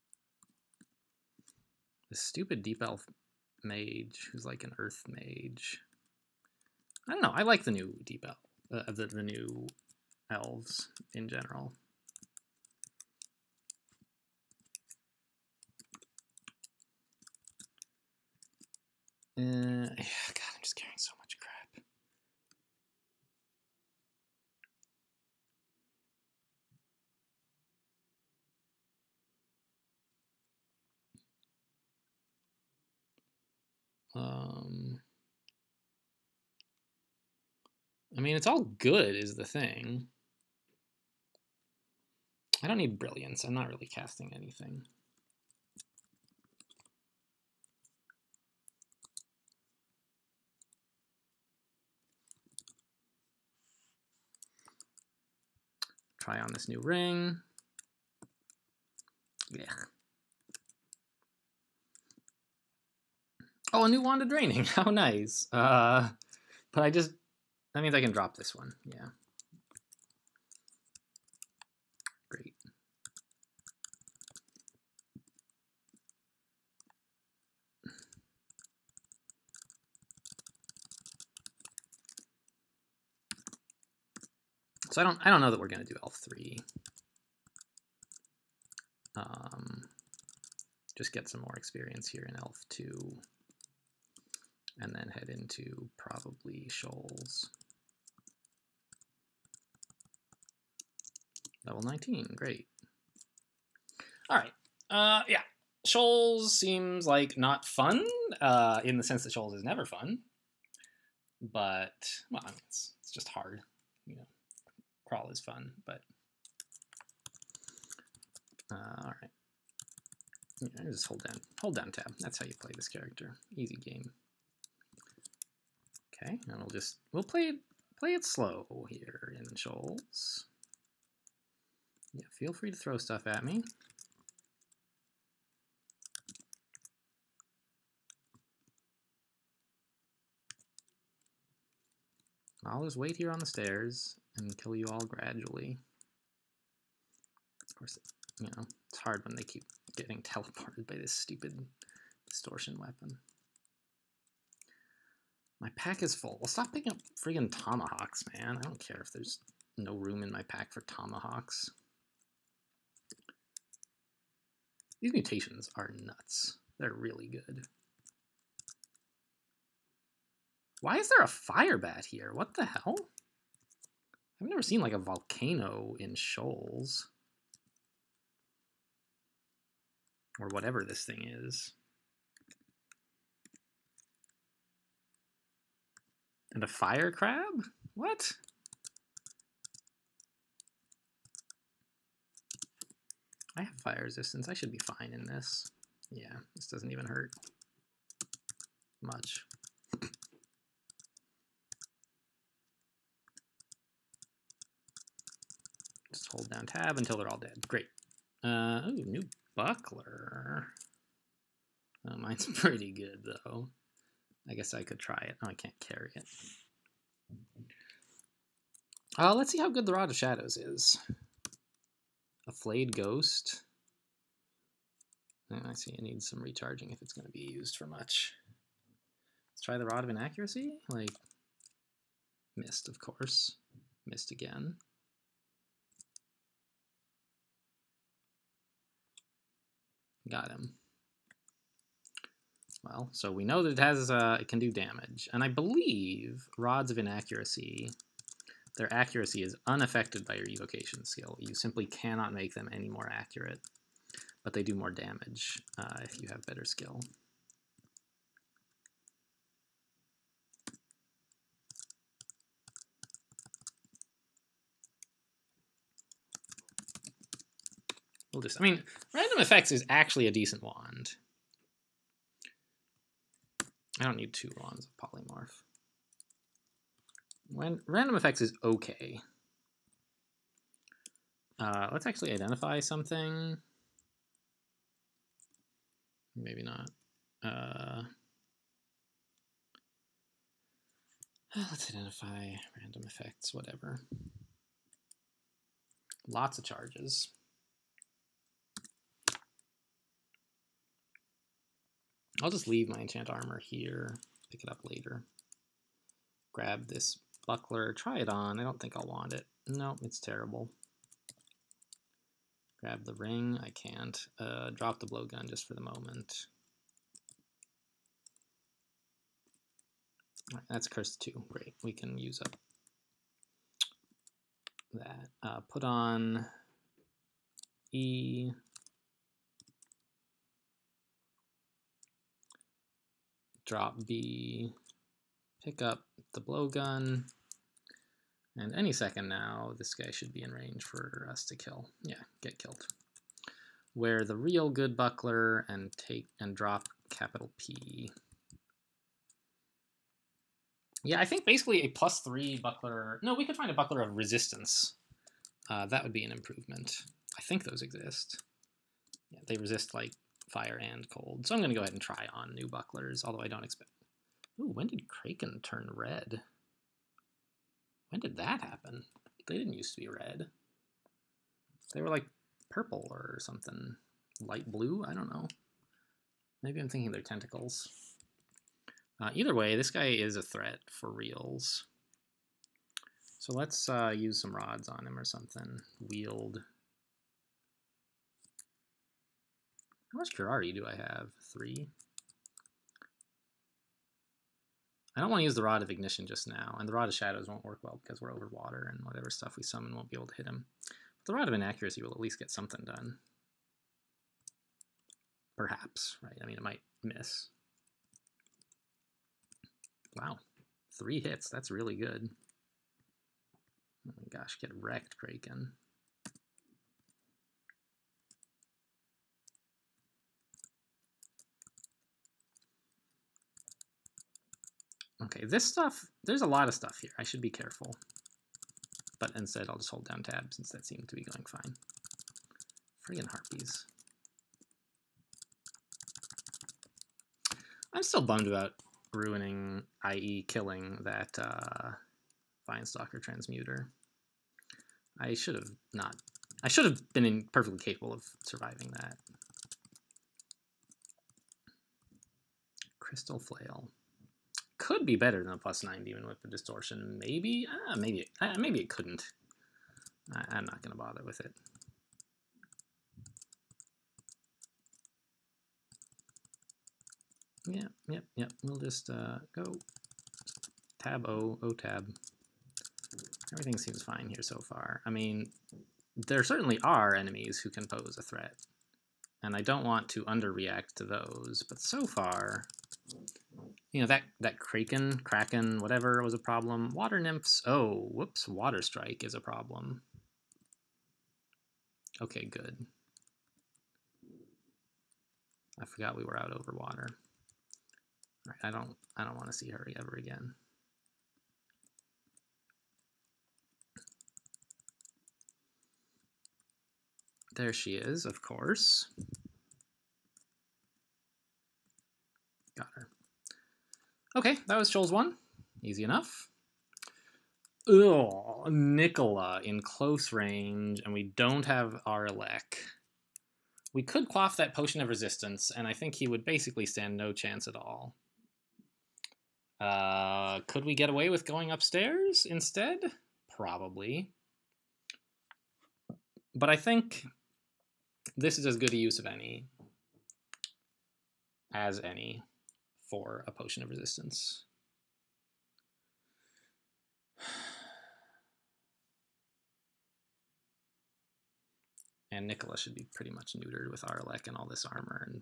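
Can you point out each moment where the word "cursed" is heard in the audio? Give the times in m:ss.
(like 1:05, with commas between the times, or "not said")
5:20.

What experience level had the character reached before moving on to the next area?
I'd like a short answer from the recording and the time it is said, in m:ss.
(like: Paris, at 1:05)
19, at 1:41.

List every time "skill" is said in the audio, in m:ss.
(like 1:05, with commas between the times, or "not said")
4:11, 4:16.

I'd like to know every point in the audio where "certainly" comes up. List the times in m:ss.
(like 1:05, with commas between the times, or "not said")
7:56.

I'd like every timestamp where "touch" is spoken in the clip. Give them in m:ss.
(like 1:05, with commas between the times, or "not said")
not said.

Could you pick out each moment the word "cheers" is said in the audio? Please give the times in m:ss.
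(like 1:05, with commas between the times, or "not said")
not said.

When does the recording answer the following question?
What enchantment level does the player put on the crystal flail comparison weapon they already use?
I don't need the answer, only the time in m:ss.
7:35.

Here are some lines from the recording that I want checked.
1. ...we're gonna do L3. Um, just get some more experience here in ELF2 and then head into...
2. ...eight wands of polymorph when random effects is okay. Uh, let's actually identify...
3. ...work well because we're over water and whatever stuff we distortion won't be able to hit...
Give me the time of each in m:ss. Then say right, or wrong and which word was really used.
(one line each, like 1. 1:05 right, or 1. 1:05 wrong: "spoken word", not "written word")
1. 1:25 right
2. 4:34 wrong: "two", not "eight"
3. 6:37 wrong: "summon", not "distortion".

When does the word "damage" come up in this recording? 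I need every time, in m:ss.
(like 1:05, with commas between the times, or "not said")
4:04, 4:14.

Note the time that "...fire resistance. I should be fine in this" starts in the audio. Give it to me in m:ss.
3:13.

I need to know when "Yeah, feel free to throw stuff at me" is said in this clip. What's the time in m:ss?
2:12.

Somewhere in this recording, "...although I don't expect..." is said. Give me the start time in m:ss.
6:03.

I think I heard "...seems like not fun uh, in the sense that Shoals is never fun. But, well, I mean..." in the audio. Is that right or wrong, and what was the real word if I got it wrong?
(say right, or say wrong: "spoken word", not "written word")
right.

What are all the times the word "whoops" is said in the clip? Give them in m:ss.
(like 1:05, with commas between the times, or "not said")
8:08.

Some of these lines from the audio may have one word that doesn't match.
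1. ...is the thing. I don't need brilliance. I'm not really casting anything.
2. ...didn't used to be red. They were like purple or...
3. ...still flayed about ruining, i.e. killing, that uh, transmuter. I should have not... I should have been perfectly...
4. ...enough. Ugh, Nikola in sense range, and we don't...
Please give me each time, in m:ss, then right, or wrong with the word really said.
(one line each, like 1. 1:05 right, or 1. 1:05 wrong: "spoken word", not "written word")
1. 0:39 right
2. 6:09 right
3. 7:18 wrong: "bummed", not "flayed"
4. 8:36 wrong: "close", not "sense".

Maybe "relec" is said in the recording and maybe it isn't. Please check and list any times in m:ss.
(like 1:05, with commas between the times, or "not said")
8:42, 9:14.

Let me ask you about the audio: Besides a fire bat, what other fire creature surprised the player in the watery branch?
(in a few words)
Fire crab.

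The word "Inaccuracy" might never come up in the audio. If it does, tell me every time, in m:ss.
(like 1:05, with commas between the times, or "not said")
3:50, 4:06, 6:41.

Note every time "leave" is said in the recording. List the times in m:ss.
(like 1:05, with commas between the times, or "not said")
5:02.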